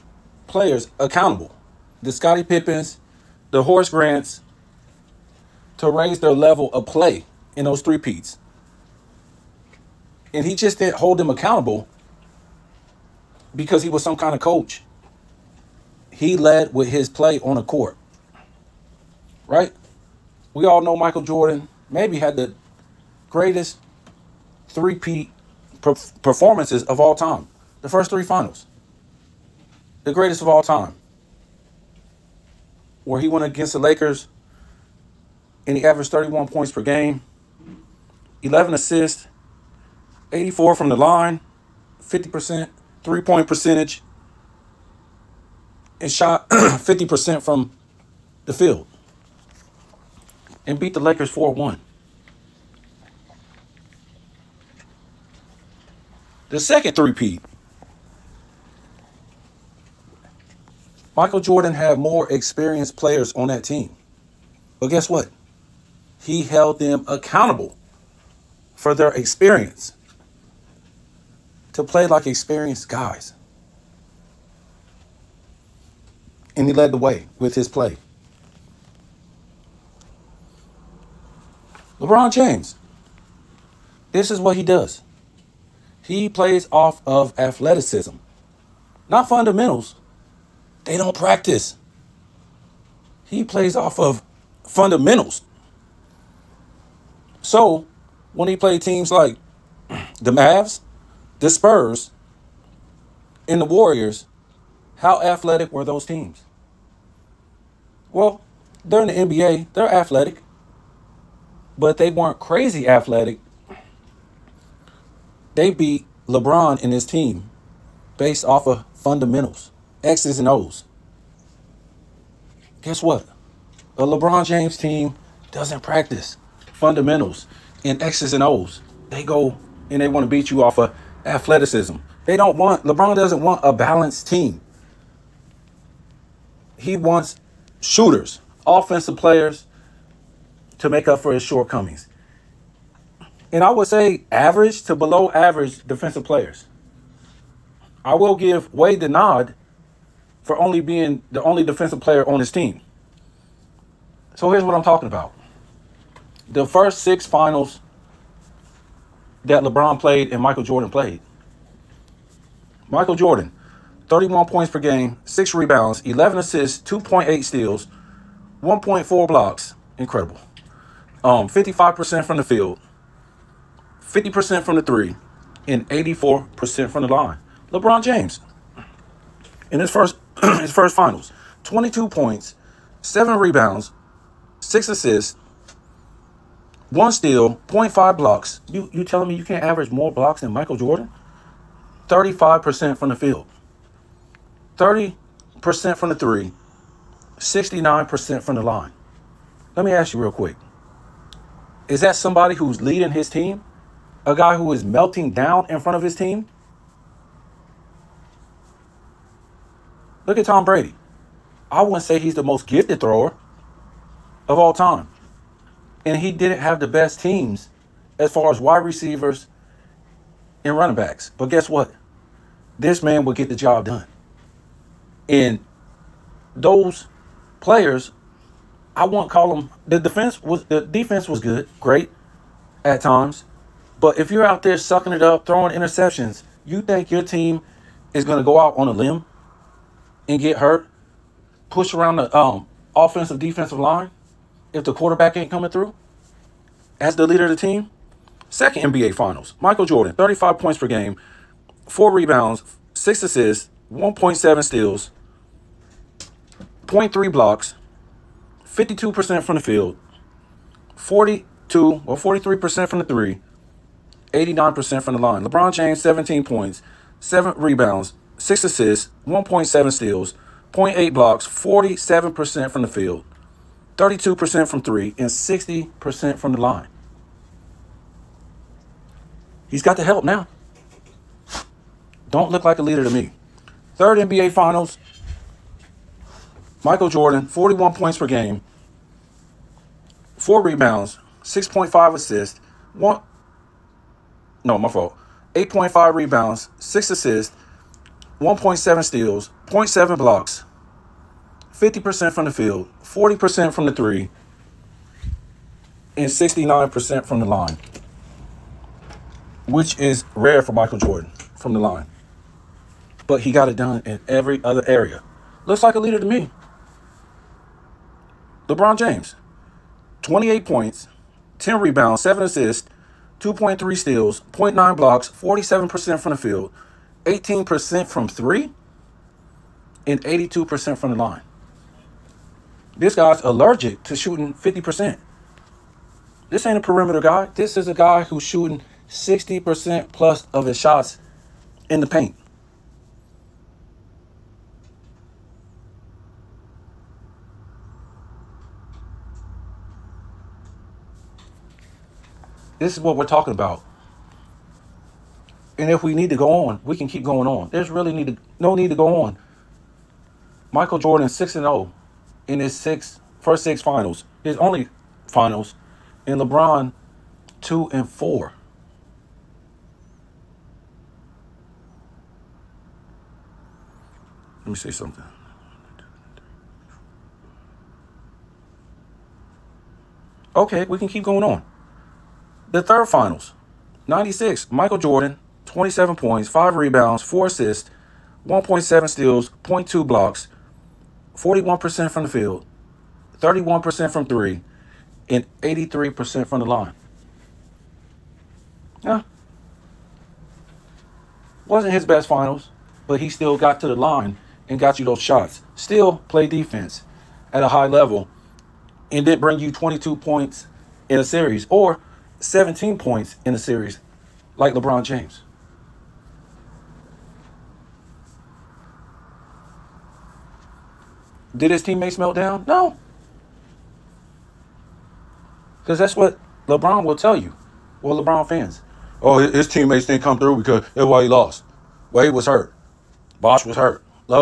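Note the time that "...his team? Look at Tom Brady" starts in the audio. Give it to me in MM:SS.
03:26.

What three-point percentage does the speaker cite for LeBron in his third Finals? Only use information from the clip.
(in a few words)
18%.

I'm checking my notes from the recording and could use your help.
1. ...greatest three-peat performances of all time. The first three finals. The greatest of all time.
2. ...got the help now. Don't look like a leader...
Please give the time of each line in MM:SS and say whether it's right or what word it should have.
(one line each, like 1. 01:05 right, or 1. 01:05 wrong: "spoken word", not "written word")
1. 00:23 right
2. 04:39 right.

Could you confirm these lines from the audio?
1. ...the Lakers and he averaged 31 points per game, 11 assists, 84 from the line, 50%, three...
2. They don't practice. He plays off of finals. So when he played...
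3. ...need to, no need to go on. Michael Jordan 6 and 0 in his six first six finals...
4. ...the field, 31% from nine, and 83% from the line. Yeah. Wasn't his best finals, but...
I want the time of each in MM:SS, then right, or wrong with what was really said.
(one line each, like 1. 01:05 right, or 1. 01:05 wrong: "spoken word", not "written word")
1. 00:33 right
2. 01:30 wrong: "fundamentals", not "finals"
3. 05:58 right
4. 06:32 wrong: "three", not "nine".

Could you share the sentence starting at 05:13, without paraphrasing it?
But he got it done in every other area.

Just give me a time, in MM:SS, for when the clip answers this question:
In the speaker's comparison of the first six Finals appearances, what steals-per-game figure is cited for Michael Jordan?
02:46.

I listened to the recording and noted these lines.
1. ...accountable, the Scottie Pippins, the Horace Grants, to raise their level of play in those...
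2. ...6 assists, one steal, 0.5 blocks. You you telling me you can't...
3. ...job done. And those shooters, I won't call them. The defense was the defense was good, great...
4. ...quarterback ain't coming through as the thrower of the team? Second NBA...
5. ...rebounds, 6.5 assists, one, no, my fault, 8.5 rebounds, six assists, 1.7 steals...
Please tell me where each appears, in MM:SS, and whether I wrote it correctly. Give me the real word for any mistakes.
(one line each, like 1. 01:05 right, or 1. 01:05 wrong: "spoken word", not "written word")
1. 00:00 right
2. 03:04 right
3. 03:43 wrong: "players", not "shooters"
4. 04:04 wrong: "leader", not "thrower"
5. 04:50 right.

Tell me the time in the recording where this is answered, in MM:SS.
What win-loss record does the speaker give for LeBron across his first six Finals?
06:07.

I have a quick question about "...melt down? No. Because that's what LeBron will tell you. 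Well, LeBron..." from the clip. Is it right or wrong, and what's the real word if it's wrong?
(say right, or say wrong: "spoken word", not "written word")
right.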